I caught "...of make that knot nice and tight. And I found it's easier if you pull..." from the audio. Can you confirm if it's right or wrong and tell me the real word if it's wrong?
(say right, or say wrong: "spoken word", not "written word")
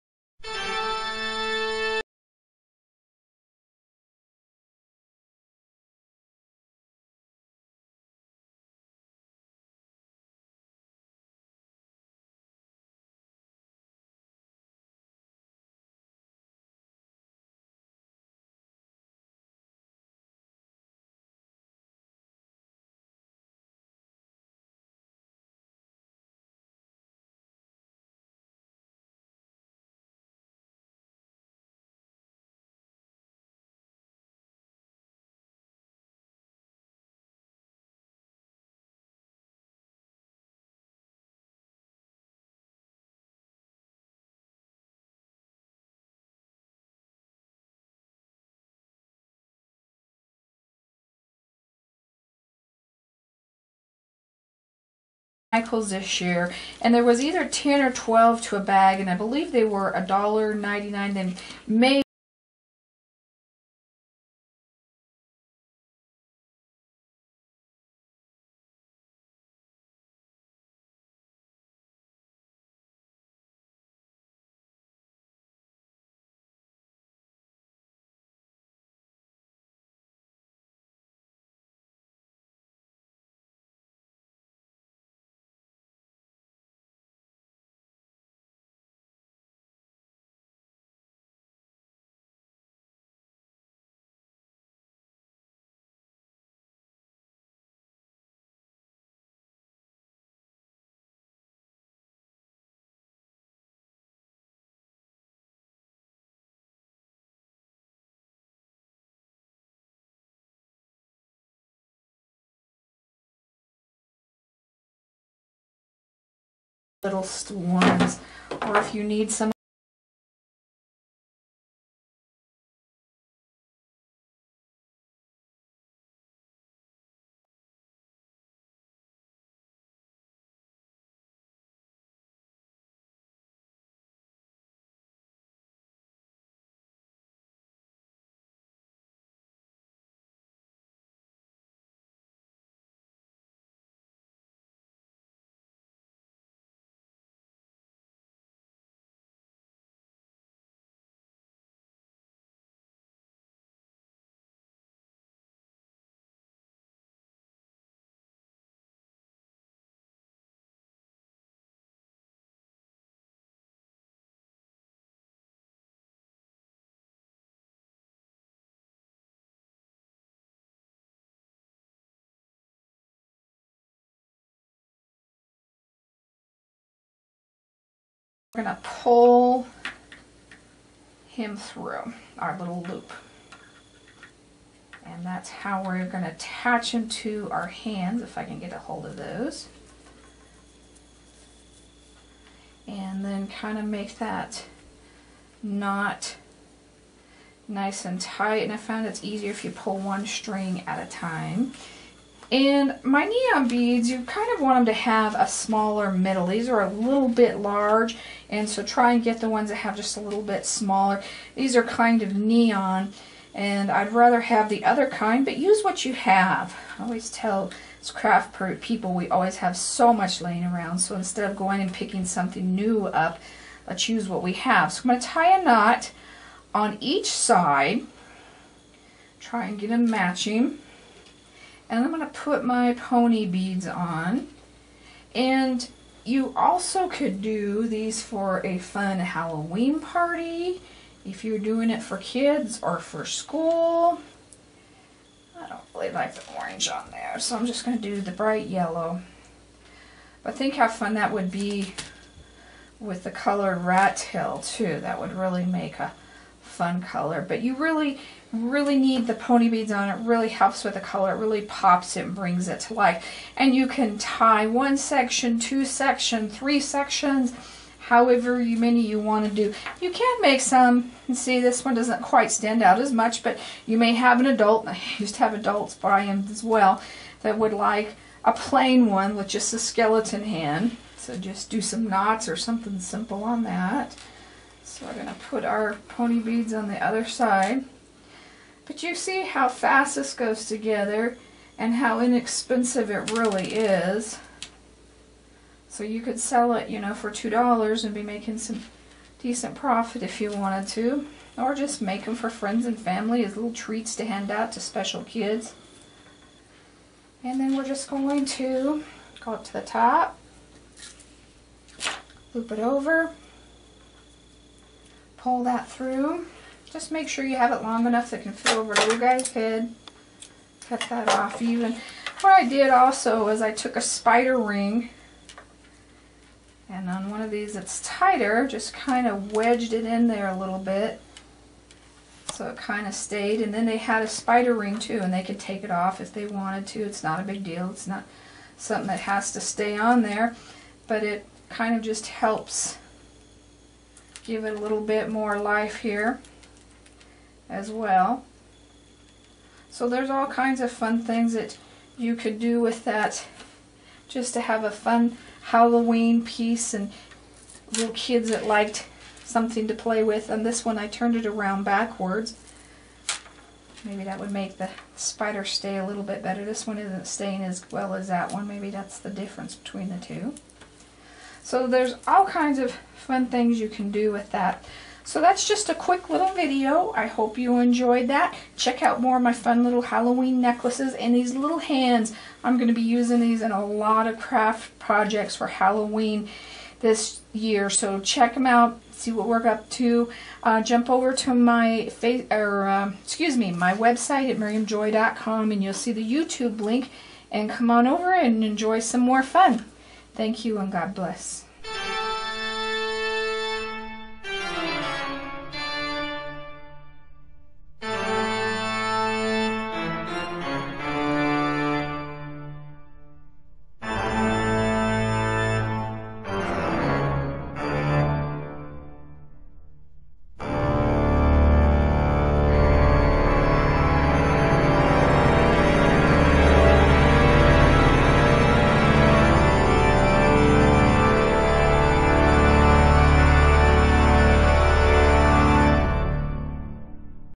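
right.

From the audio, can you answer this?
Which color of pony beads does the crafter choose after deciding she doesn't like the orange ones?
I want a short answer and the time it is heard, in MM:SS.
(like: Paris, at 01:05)
bright yellow, at 04:08.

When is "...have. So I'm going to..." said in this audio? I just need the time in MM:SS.
03:44.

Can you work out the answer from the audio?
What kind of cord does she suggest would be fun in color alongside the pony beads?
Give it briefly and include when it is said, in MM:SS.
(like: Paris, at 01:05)
rat tail, at 04:13.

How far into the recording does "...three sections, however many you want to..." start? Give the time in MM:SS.
04:26.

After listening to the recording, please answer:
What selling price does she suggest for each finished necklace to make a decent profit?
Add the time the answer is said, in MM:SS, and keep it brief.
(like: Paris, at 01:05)
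$2, at 04:57.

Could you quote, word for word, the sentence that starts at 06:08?
Maybe that's the difference between the two.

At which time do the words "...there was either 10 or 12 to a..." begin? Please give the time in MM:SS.
00:56.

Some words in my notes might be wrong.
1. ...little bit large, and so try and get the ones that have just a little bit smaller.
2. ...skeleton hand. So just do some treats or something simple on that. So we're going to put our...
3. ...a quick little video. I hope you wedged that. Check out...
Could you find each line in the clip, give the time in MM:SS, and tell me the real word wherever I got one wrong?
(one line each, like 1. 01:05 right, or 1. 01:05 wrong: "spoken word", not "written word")
1. 03:26 right
2. 04:39 wrong: "knots", not "treats"
3. 06:15 wrong: "enjoyed", not "wedged".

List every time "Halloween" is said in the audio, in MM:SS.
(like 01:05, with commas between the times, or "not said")
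03:59, 05:55, 06:20, 06:25.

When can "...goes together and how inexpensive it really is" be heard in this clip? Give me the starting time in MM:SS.
04:50.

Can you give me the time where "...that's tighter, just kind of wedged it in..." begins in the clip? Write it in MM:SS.
05:27.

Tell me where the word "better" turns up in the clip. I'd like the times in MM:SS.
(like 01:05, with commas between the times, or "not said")
06:06.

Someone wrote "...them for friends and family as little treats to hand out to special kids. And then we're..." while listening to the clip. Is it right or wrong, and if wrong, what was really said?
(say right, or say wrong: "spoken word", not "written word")
right.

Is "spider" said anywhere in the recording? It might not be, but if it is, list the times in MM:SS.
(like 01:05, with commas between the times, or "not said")
05:24, 05:34, 06:05.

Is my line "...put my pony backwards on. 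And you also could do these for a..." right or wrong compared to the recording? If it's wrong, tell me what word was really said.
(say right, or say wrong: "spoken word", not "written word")
wrong: "beads", not "backwards".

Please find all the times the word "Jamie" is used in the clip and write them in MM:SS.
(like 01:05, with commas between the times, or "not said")
not said.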